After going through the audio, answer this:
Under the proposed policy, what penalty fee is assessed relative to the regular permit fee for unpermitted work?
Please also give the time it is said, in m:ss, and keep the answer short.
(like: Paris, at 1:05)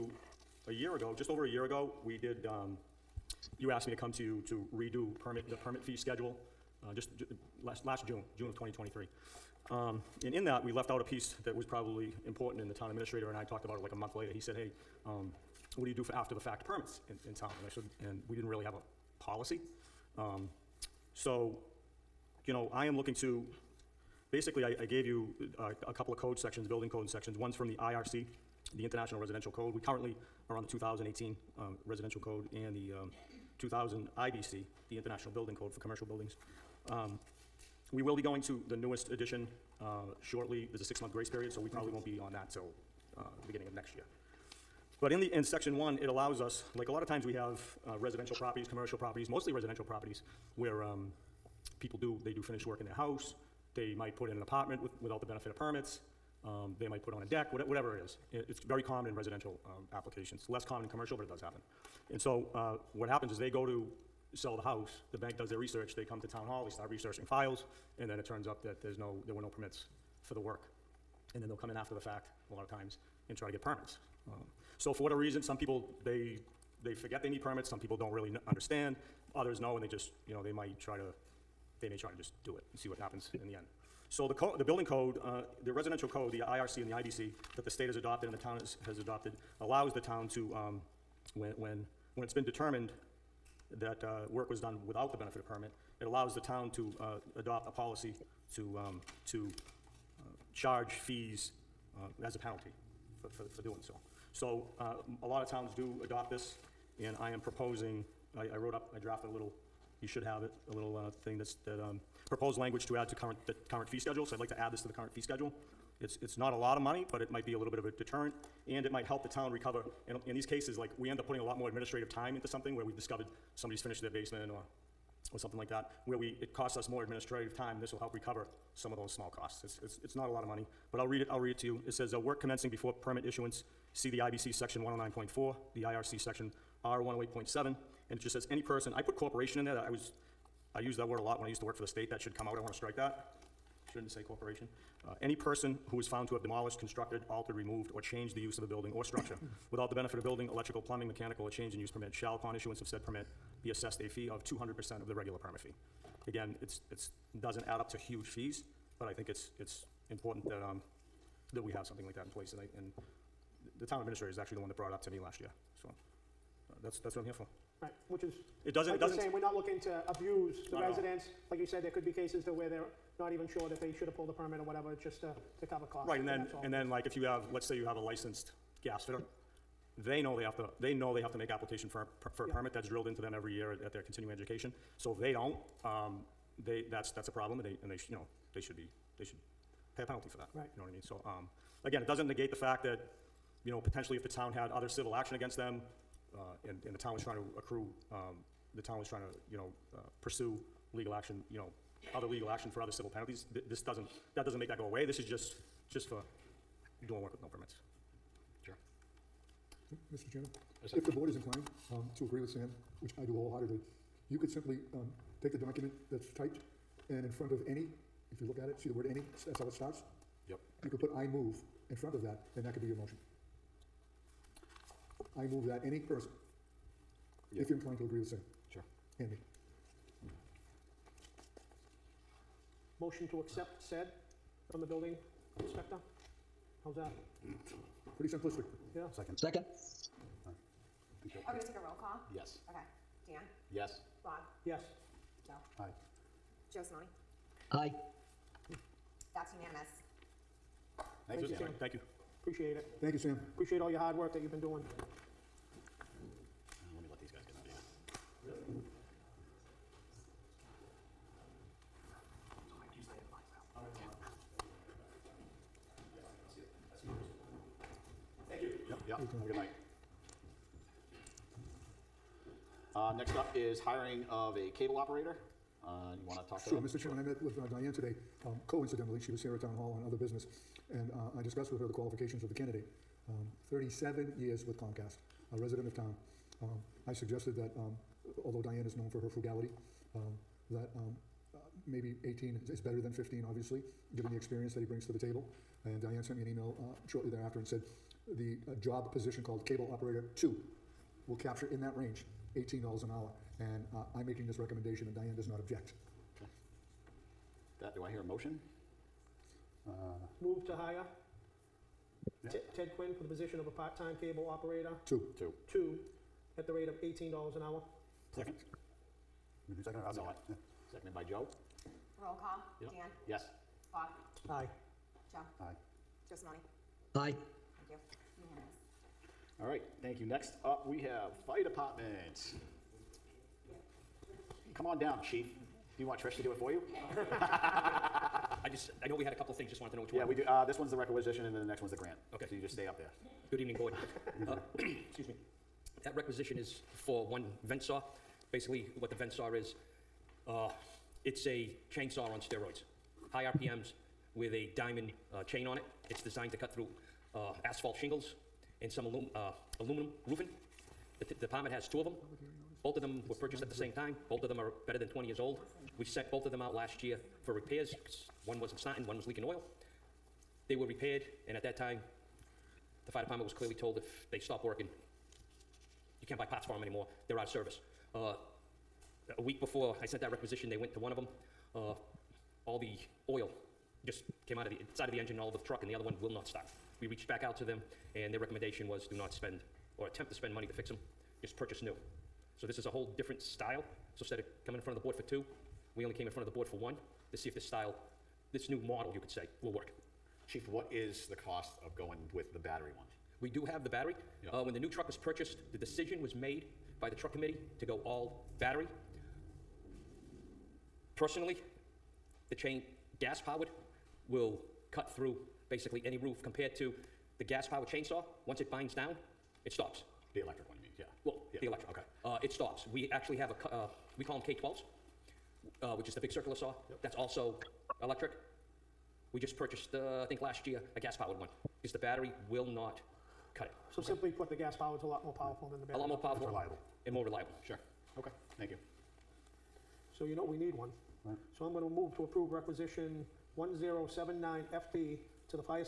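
200%, at 2:34.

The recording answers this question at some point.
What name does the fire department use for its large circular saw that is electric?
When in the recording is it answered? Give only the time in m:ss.
7:04.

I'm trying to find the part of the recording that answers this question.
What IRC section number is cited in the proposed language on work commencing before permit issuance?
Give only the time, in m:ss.
2:16.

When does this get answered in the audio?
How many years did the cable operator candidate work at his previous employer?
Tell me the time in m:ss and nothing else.
4:43.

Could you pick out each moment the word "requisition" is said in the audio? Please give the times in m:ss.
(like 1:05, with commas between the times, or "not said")
5:40, 5:46, 6:20, 7:22.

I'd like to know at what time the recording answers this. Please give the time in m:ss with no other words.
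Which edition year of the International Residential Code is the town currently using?
0:30.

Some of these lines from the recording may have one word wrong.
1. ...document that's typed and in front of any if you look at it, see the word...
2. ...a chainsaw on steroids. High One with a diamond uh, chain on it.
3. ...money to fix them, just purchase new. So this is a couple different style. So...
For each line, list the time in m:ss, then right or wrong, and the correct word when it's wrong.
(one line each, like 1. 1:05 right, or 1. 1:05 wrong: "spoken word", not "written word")
1. 3:35 right
2. 5:51 wrong: "RPMs", not "One"
3. 6:30 wrong: "whole", not "couple".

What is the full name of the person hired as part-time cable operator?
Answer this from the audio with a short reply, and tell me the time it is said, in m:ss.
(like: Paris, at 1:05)
Ted Quinn, at 5:12.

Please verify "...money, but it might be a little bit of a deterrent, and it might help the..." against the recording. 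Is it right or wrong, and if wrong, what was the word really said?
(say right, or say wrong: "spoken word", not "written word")
right.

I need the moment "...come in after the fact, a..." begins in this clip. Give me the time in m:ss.
1:11.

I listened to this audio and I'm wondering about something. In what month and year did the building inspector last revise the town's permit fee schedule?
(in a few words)
June 2023.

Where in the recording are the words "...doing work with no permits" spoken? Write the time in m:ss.
3:27.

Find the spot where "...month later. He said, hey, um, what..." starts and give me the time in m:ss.
0:13.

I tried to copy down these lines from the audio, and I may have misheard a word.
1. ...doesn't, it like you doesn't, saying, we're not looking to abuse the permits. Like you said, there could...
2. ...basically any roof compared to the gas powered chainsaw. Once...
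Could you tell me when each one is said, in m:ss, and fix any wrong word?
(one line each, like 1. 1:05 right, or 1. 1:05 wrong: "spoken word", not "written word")
1. 2:48 wrong: "residents", not "permits"
2. 6:55 right.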